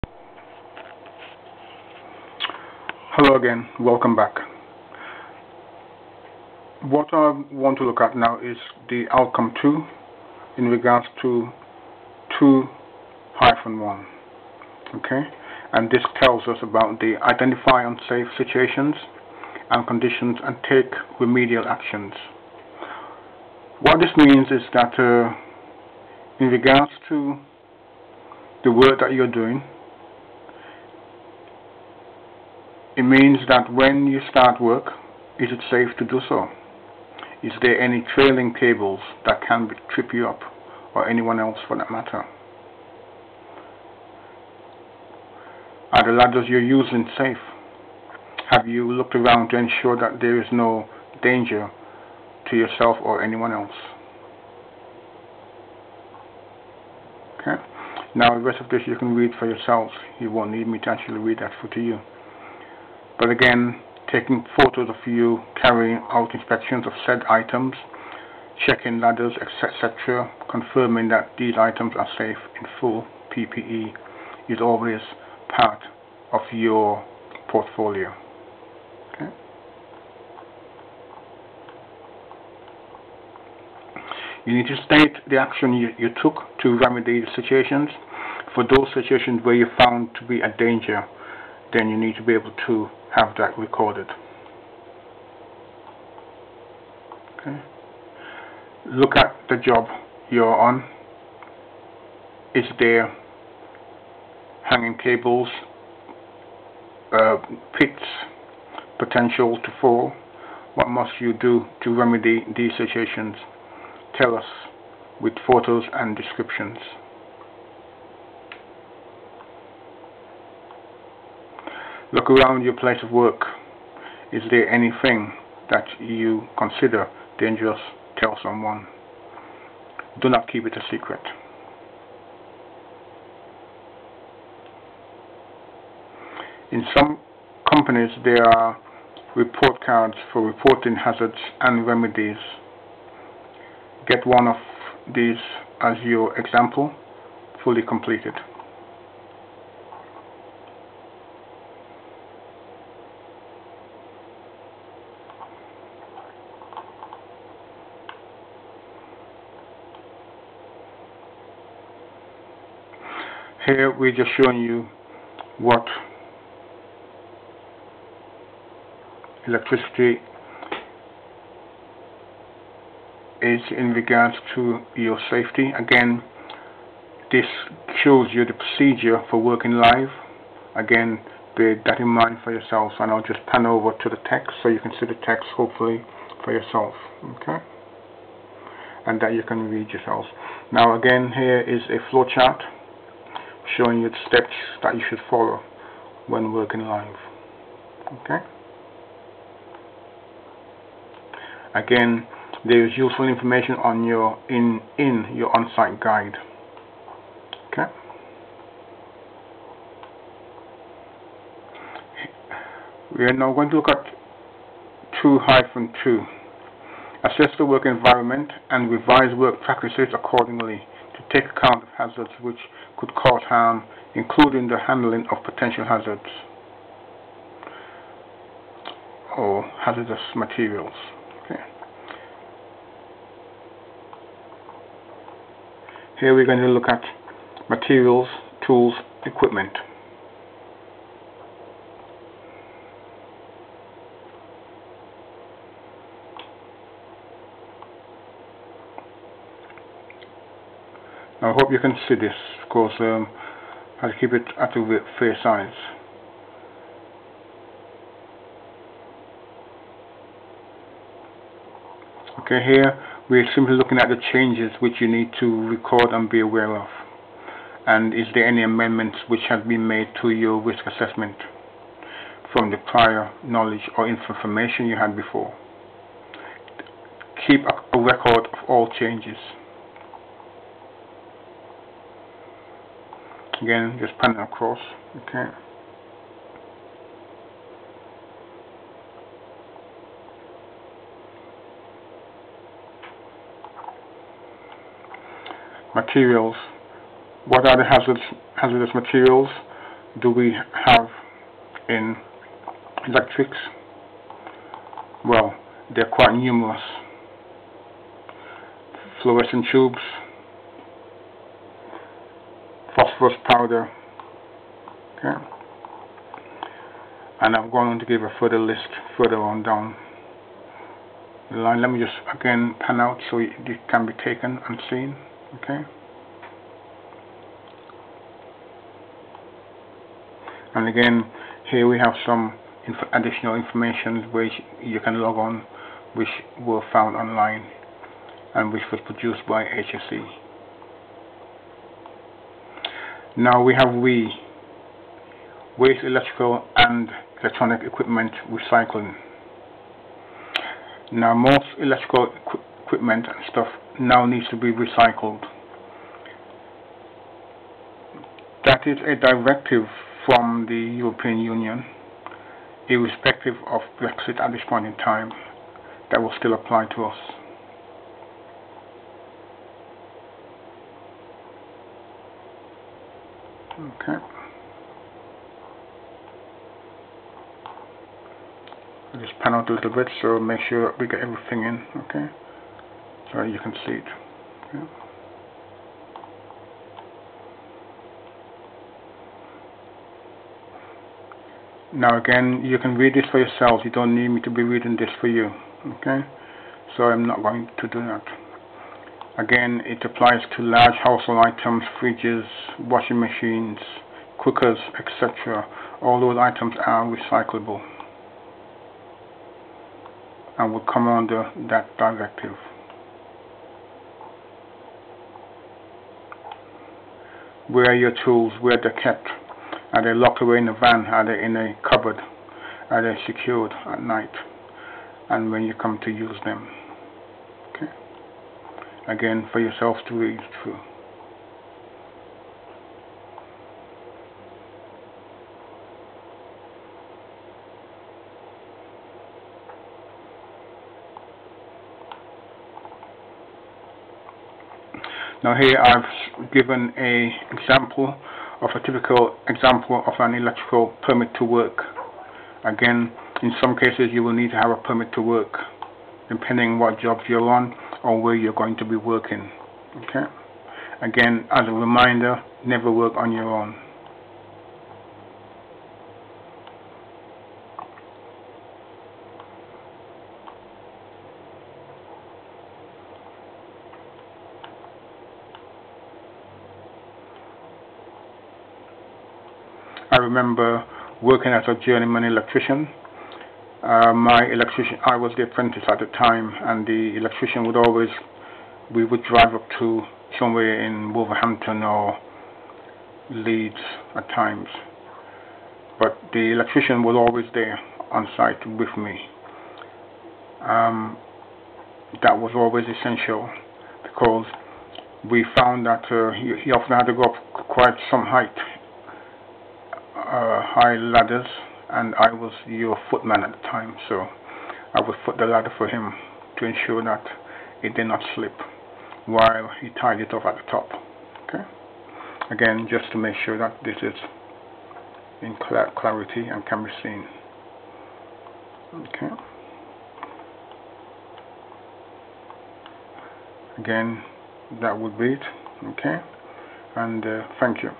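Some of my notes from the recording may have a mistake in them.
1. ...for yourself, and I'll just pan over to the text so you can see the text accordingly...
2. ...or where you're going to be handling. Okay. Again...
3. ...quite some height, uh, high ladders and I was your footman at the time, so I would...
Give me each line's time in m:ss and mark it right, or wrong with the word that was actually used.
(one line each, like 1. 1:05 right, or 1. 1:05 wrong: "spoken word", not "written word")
1. 3:02 wrong: "hopefully", not "accordingly"
2. 7:38 wrong: "working", not "handling"
3. 8:27 right.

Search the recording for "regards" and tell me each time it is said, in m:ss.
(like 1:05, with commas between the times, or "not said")
0:10, 0:26, 2:53.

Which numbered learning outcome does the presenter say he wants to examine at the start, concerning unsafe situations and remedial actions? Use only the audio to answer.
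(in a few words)
Outcome 2.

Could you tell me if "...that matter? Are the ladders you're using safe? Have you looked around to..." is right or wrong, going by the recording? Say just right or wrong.
right.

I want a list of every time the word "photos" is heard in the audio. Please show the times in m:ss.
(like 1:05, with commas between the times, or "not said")
1:04, 1:55.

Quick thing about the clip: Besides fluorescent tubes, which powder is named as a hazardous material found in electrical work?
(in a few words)
Phosphorus powder.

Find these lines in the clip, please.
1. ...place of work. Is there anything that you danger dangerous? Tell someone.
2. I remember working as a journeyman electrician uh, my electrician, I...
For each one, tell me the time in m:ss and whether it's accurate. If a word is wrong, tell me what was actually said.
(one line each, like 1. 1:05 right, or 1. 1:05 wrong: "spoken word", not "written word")
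1. 2:02 wrong: "consider", not "danger"
2. 8:00 right.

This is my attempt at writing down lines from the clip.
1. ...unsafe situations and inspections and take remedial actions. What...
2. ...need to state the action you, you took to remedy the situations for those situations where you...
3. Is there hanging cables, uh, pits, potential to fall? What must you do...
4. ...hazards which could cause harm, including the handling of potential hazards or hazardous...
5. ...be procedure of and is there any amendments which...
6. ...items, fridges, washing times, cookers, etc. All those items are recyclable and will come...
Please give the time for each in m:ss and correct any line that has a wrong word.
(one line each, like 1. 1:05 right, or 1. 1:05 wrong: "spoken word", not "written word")
1. 0:17 wrong: "conditions", not "inspections"
2. 1:24 right
3. 1:42 right
4. 3:41 right
5. 4:26 wrong: "aware", not "procedure"
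6. 6:41 wrong: "machines", not "times".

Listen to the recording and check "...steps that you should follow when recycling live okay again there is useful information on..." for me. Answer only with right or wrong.
wrong.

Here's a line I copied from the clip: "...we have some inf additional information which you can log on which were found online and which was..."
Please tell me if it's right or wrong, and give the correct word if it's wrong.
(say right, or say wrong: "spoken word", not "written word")
right.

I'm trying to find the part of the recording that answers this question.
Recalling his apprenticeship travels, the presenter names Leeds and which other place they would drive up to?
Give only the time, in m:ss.
8:11.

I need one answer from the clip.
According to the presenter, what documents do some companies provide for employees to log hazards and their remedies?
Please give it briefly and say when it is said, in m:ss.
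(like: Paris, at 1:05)
Report cards, at 2:19.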